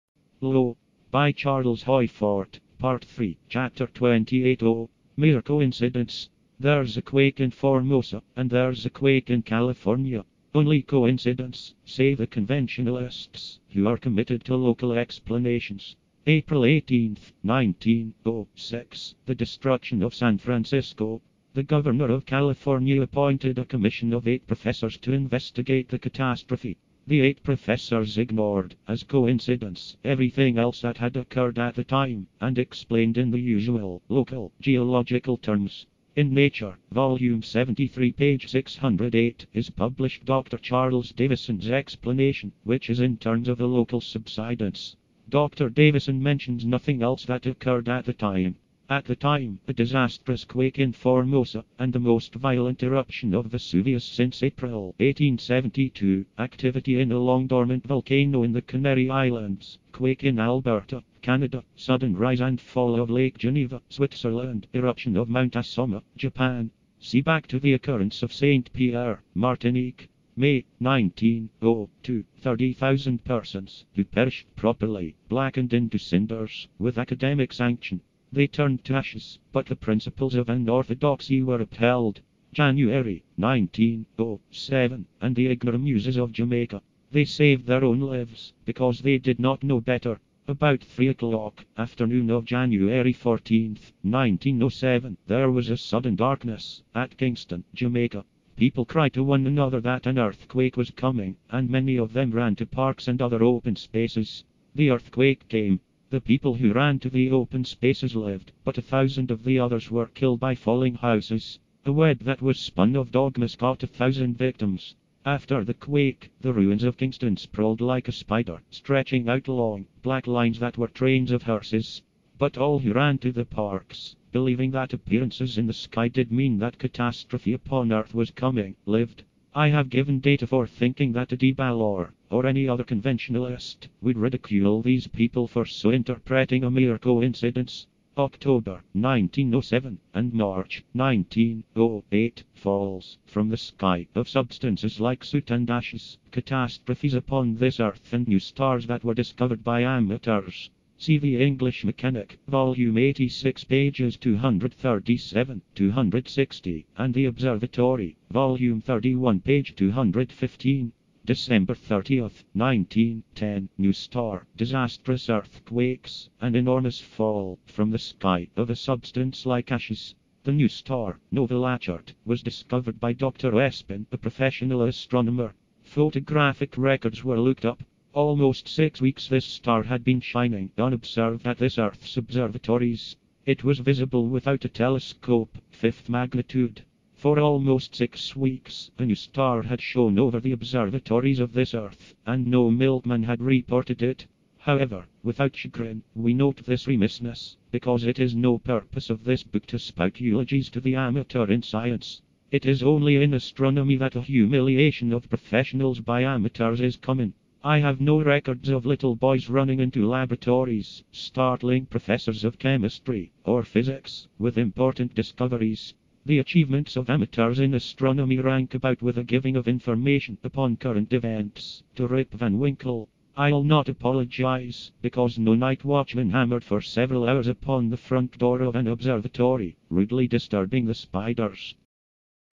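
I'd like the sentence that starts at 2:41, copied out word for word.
December 30th, 1910, New Star, disastrous earthquakes, an enormous fall from the sky of a substance like ashes.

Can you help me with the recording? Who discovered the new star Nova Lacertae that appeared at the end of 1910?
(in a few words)
Dr. Espin.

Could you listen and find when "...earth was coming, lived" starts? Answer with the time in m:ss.
2:07.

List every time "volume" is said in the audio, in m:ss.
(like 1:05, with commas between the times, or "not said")
0:36, 2:32, 2:38.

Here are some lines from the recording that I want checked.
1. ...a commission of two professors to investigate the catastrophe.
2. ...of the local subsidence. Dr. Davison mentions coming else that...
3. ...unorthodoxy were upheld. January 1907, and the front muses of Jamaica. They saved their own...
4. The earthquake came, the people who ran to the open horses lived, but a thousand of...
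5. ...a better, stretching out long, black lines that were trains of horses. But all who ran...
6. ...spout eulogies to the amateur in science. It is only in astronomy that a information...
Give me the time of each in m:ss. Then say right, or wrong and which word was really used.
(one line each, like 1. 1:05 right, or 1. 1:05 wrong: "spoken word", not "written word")
1. 0:23 wrong: "eight", not "two"
2. 0:43 wrong: "nothing", not "coming"
3. 1:20 wrong: "ignorant", not "front"
4. 1:44 wrong: "spaces", not "horses"
5. 1:58 wrong: "spider", not "better"
6. 3:19 wrong: "humiliation", not "information".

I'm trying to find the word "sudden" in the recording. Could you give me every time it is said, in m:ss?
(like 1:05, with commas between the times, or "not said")
1:01, 1:35.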